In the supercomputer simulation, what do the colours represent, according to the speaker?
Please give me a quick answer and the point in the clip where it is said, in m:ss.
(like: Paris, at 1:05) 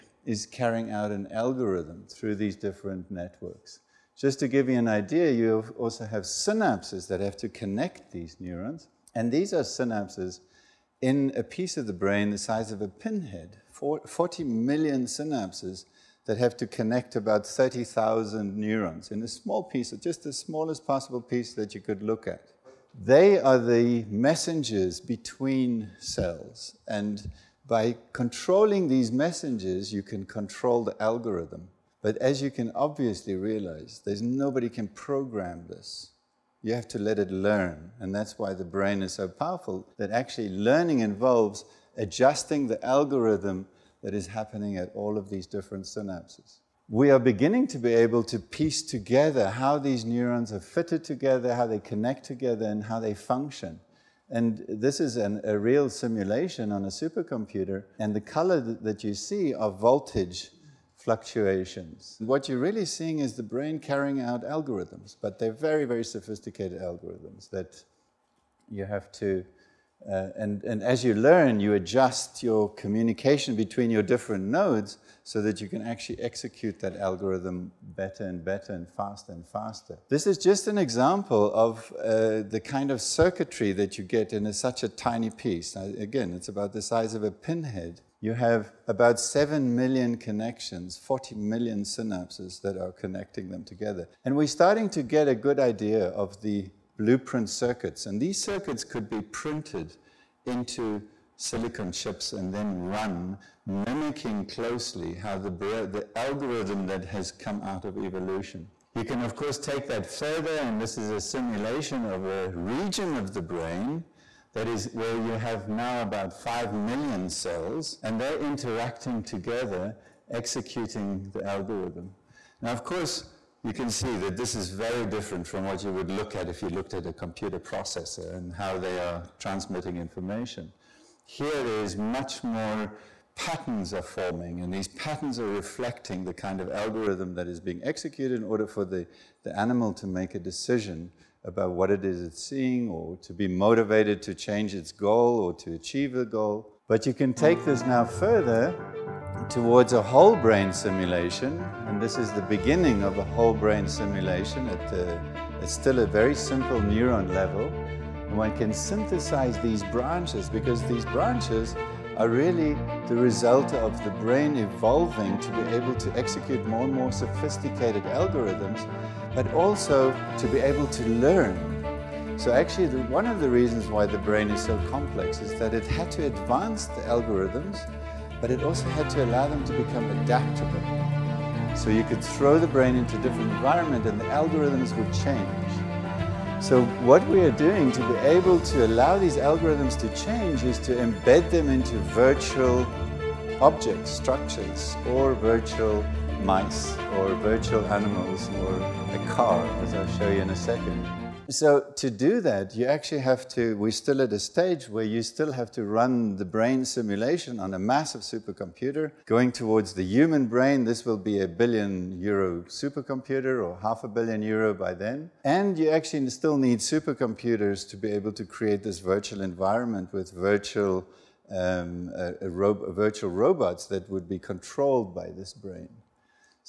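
Voltage fluctuations, at 0:59.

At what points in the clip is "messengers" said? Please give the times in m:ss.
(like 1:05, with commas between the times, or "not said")
0:24, 0:29.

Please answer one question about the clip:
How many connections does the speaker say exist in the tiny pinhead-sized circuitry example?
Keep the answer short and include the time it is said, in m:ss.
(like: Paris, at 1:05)
7 million, at 1:29.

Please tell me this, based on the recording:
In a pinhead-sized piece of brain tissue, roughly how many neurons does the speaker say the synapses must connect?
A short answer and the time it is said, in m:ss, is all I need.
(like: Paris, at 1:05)
30,000, at 0:17.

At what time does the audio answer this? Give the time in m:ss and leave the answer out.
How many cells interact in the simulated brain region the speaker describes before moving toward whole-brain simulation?
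1:56.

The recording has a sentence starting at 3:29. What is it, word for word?
Going towards the human brain, this will be a billion euro supercomputer or half a billion euro by then.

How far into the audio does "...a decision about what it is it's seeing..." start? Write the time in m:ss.
2:20.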